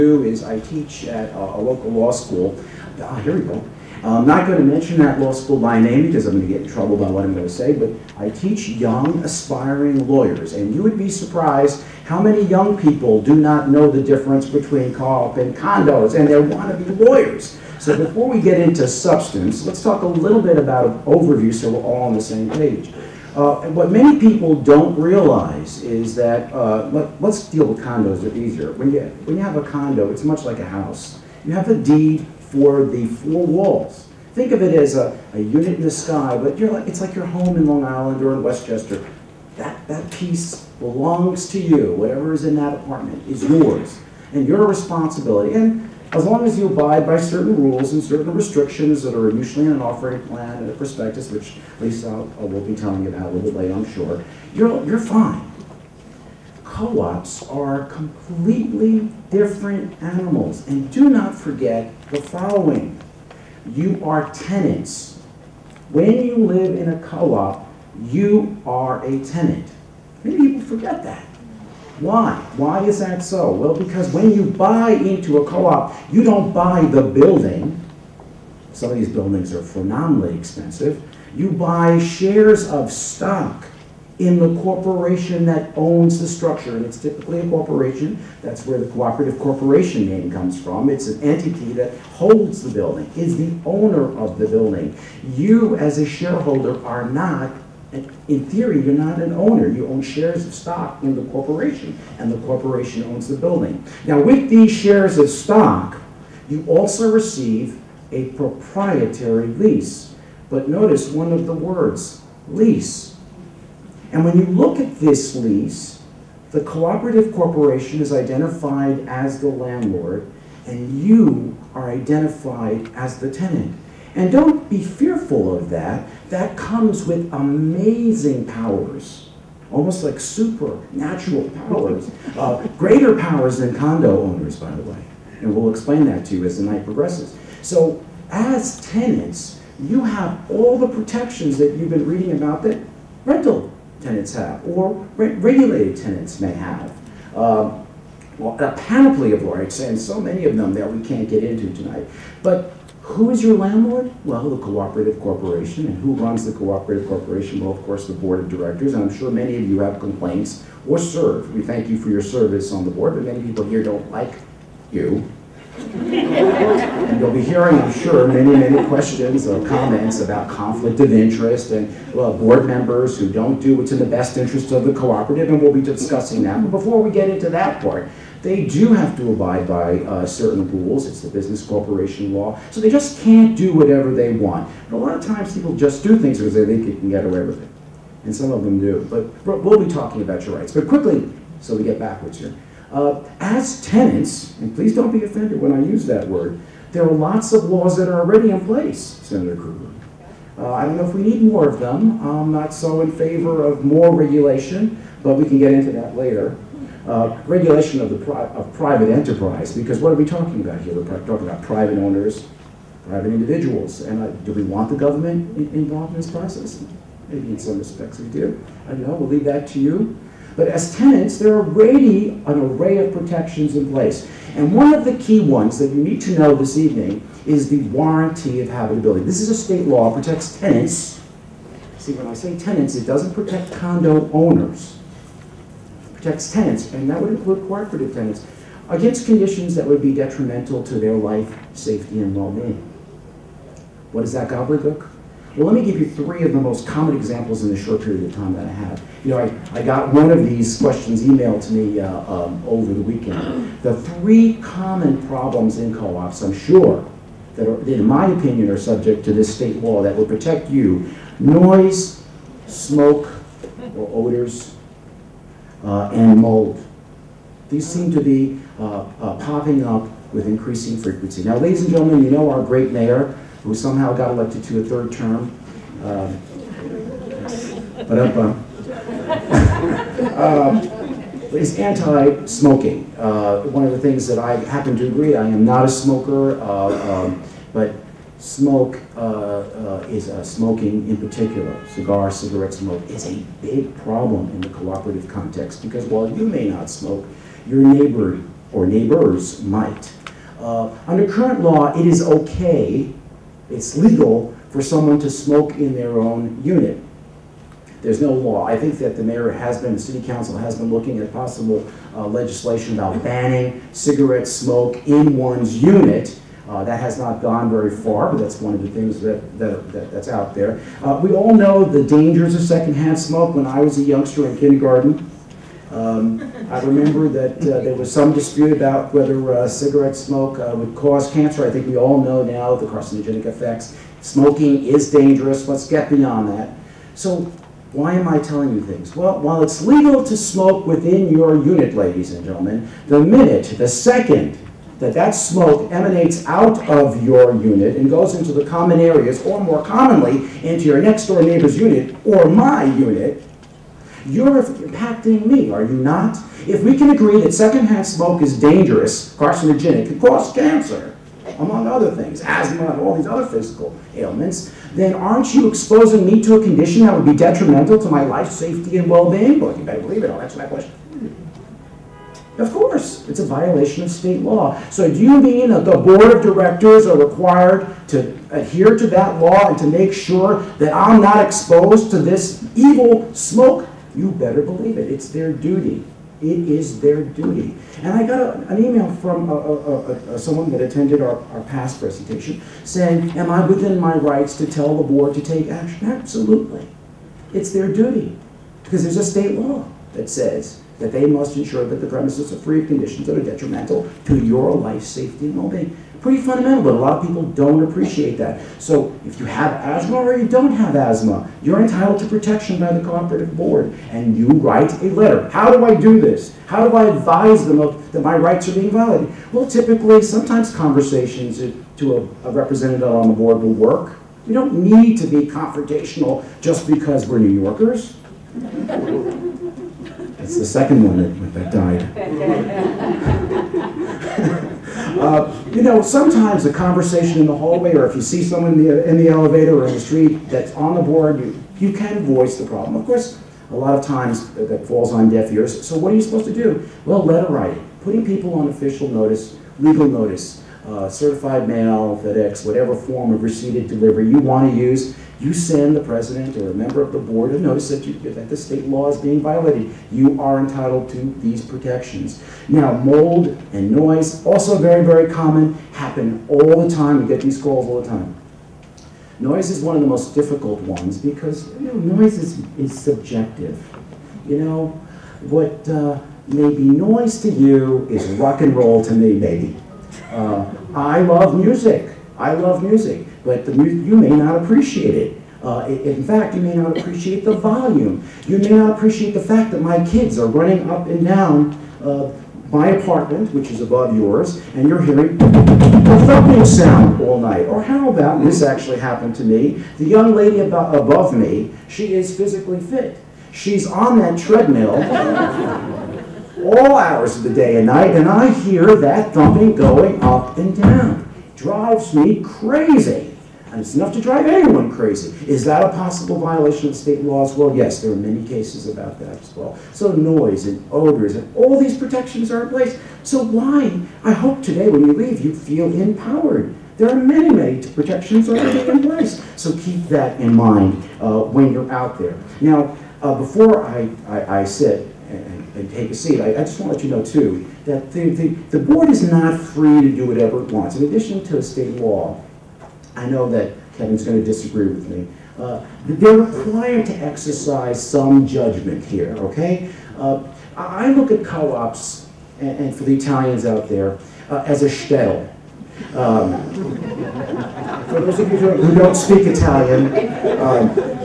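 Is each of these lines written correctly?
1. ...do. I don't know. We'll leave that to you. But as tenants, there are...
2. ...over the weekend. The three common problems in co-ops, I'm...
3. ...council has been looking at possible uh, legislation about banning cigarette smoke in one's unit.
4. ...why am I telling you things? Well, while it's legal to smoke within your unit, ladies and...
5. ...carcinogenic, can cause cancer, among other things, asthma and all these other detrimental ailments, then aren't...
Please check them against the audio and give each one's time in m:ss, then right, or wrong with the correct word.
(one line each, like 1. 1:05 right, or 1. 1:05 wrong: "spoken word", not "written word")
1. 3:38 right
2. 4:12 right
3. 5:10 right
4. 5:37 right
5. 5:59 wrong: "physical", not "detrimental".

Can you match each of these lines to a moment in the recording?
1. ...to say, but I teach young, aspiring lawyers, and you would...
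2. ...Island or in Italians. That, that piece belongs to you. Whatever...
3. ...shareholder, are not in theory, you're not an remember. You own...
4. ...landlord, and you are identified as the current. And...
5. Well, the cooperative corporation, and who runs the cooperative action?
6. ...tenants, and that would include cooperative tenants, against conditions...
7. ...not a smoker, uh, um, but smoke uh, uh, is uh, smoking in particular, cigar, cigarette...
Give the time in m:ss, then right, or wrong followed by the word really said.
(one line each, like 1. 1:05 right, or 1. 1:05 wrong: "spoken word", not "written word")
1. 0:07 right
2. 0:37 wrong: "Westchester", not "Italians"
3. 1:36 wrong: "owner", not "remember"
4. 1:59 wrong: "tenant", not "current"
5. 2:34 wrong: "corporation", not "action"
6. 3:56 right
7. 4:45 right.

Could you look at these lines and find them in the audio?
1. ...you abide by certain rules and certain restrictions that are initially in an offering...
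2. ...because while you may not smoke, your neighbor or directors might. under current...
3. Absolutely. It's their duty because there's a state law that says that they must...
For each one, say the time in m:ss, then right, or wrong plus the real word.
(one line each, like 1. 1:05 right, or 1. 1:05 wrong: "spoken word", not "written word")
1. 0:46 right
2. 4:55 wrong: "neighbors", not "directors"
3. 6:36 right.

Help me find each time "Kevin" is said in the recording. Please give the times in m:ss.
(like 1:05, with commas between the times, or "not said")
9:03.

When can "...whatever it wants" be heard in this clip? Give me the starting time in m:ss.
9:00.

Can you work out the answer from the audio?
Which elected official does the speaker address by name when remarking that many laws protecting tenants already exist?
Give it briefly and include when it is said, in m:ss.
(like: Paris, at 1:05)
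Senator Krueger, at 3:18.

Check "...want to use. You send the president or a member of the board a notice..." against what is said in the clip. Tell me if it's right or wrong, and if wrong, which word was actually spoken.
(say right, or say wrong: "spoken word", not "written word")
right.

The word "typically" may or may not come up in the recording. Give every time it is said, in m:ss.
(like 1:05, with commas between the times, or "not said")
1:27, 6:59.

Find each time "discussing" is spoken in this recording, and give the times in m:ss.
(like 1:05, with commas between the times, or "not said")
2:55.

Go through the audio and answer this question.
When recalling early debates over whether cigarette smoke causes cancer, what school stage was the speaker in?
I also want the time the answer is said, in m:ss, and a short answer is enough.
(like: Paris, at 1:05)
kindergarten, at 5:24.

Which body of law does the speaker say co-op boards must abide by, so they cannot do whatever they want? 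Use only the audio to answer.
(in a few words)
business corporation law.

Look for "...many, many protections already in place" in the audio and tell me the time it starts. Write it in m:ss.
8:47.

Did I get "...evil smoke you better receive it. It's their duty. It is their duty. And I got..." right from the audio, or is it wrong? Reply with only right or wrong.
wrong.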